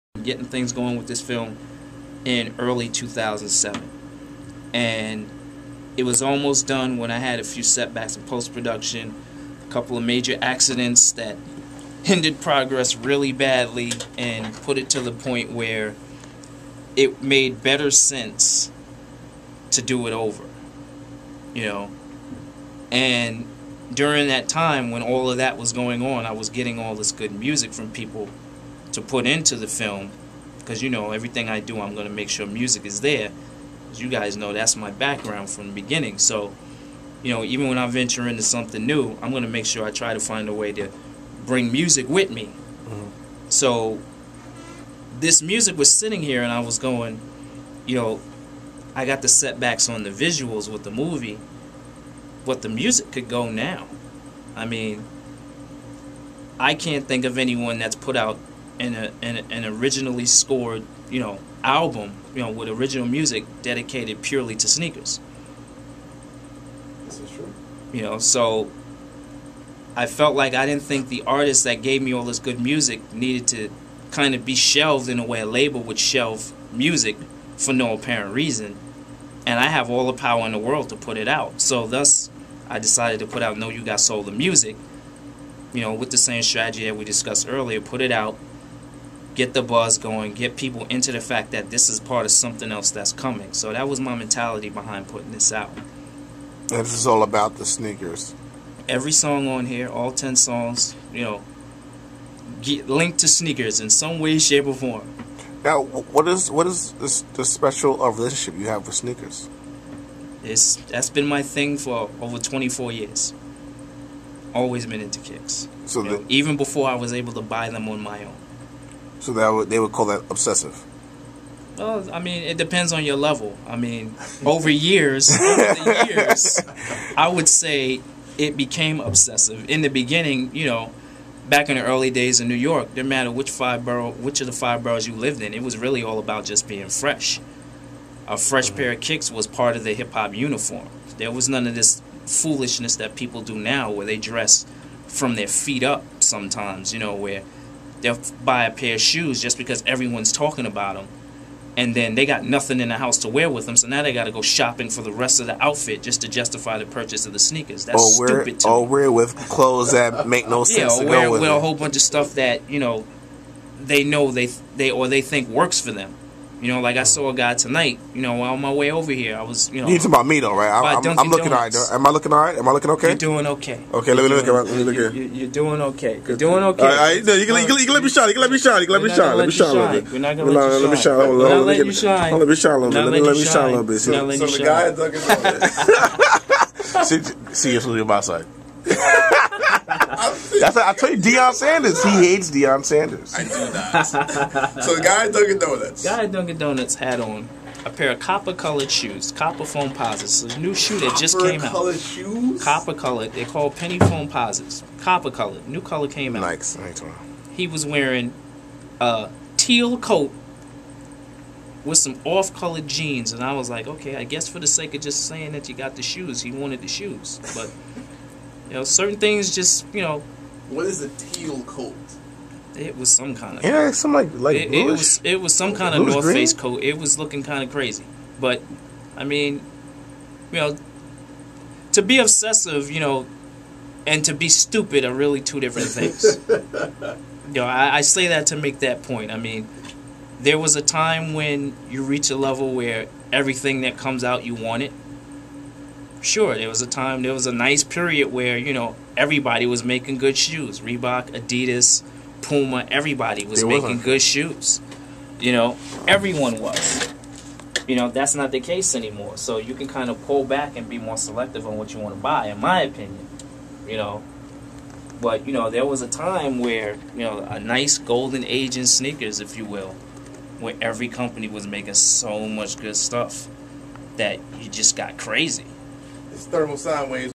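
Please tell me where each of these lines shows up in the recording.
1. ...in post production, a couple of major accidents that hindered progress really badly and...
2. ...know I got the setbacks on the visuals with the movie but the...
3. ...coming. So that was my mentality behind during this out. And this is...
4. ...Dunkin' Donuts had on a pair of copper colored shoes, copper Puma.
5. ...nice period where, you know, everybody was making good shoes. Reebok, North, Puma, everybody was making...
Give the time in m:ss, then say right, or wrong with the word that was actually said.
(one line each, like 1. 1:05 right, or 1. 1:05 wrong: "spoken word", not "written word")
1. 0:08 right
2. 0:47 right
3. 1:33 wrong: "putting", not "during"
4. 3:16 wrong: "Foamposites", not "Puma"
5. 4:07 wrong: "Adidas", not "North".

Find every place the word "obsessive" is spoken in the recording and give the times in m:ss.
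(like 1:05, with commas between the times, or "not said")
2:00, 2:08, 3:52.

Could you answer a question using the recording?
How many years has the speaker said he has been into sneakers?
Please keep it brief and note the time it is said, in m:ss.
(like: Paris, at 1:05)
24, at 1:52.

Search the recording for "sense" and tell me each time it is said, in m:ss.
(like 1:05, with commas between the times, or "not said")
0:17, 2:40.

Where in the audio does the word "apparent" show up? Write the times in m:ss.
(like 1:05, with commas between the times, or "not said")
1:17.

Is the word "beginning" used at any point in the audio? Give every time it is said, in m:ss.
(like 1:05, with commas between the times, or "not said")
0:35, 2:09.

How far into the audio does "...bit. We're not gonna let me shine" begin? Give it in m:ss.
3:00.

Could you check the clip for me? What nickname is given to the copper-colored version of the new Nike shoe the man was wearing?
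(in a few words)
Penny Foamposites.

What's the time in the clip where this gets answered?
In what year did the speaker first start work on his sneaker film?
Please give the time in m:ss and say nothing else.
0:02.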